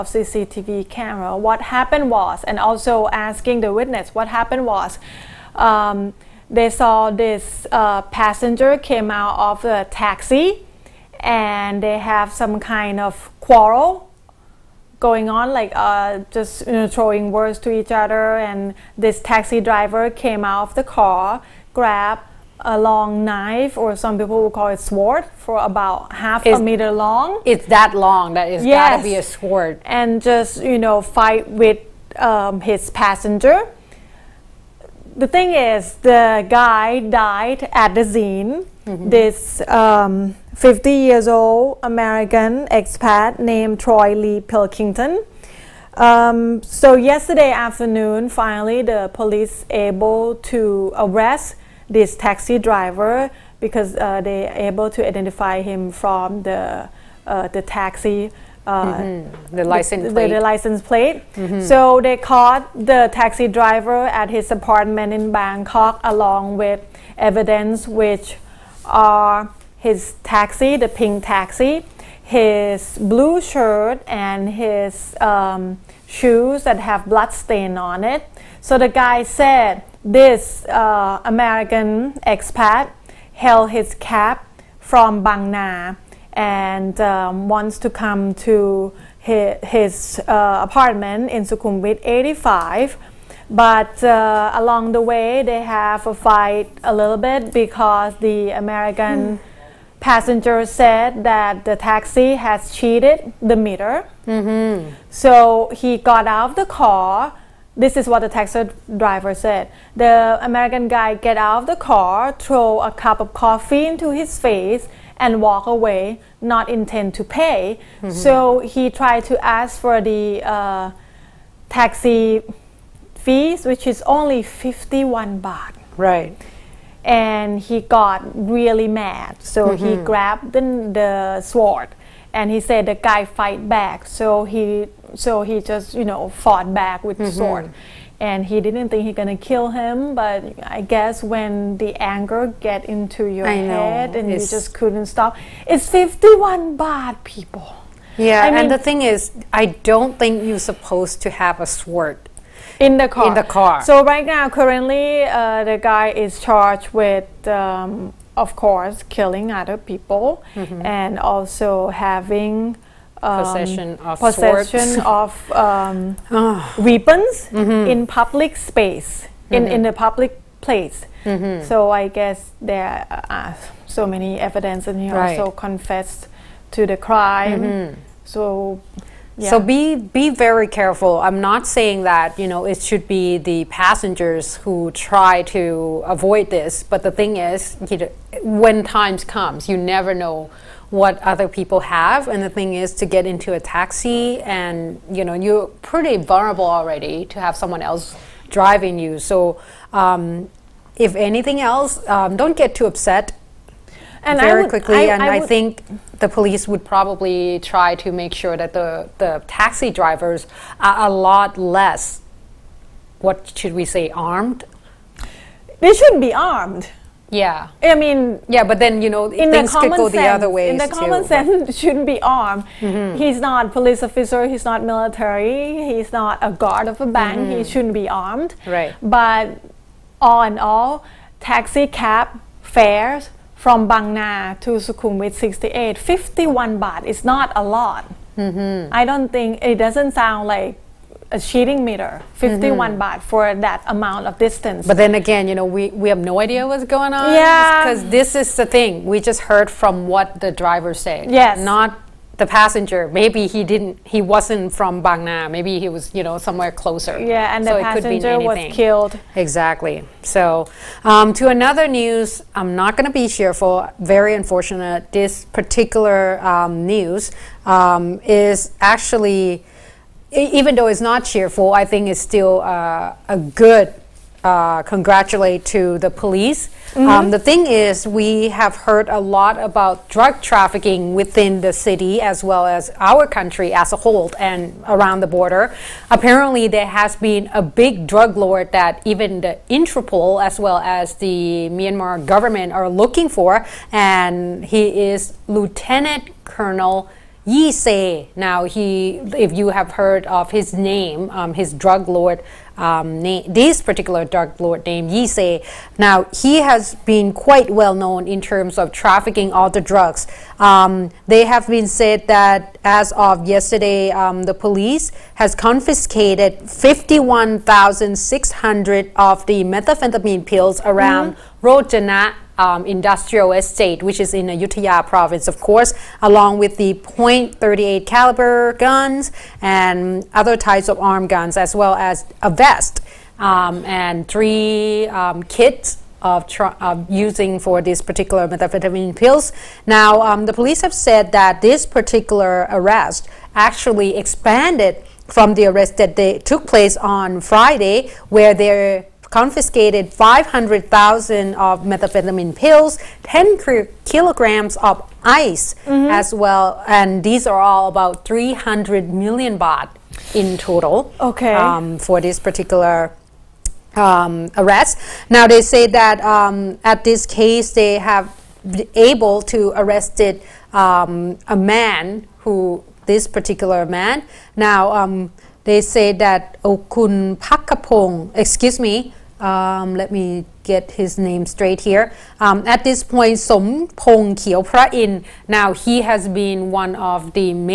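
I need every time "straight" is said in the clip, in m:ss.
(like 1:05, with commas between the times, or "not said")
6:21.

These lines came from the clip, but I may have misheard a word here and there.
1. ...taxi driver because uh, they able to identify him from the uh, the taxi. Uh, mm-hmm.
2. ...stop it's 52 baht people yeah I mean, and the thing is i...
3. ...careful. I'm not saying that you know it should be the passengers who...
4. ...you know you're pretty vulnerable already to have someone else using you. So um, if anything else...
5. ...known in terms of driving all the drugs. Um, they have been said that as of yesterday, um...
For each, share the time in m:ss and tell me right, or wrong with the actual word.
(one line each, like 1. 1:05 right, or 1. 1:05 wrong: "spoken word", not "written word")
1. 0:52 right
2. 2:25 wrong: "51", not "52"
3. 3:00 right
4. 3:15 wrong: "driving", not "using"
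5. 5:07 wrong: "trafficking", not "driving".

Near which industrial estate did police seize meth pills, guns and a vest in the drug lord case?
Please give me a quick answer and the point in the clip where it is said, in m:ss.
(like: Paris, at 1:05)
Rojana, at 5:21.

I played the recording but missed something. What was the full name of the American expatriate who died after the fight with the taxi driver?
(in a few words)
Troy Lee Pilkington.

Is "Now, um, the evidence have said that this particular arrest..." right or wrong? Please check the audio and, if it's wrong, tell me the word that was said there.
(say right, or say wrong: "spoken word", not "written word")
wrong: "police", not "evidence".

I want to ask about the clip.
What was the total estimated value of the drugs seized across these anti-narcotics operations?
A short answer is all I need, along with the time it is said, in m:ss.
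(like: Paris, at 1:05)
300 million baht, at 5:58.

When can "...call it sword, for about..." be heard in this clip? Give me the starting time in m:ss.
0:24.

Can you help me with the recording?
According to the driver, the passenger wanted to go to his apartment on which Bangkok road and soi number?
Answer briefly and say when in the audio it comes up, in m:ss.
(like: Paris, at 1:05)
Sukhumvit 85, at 1:31.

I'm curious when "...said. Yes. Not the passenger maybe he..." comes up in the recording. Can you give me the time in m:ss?
4:10.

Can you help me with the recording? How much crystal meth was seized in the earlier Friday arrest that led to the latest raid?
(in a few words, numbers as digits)
10 kilograms.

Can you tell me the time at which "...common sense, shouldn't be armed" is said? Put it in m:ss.
3:40.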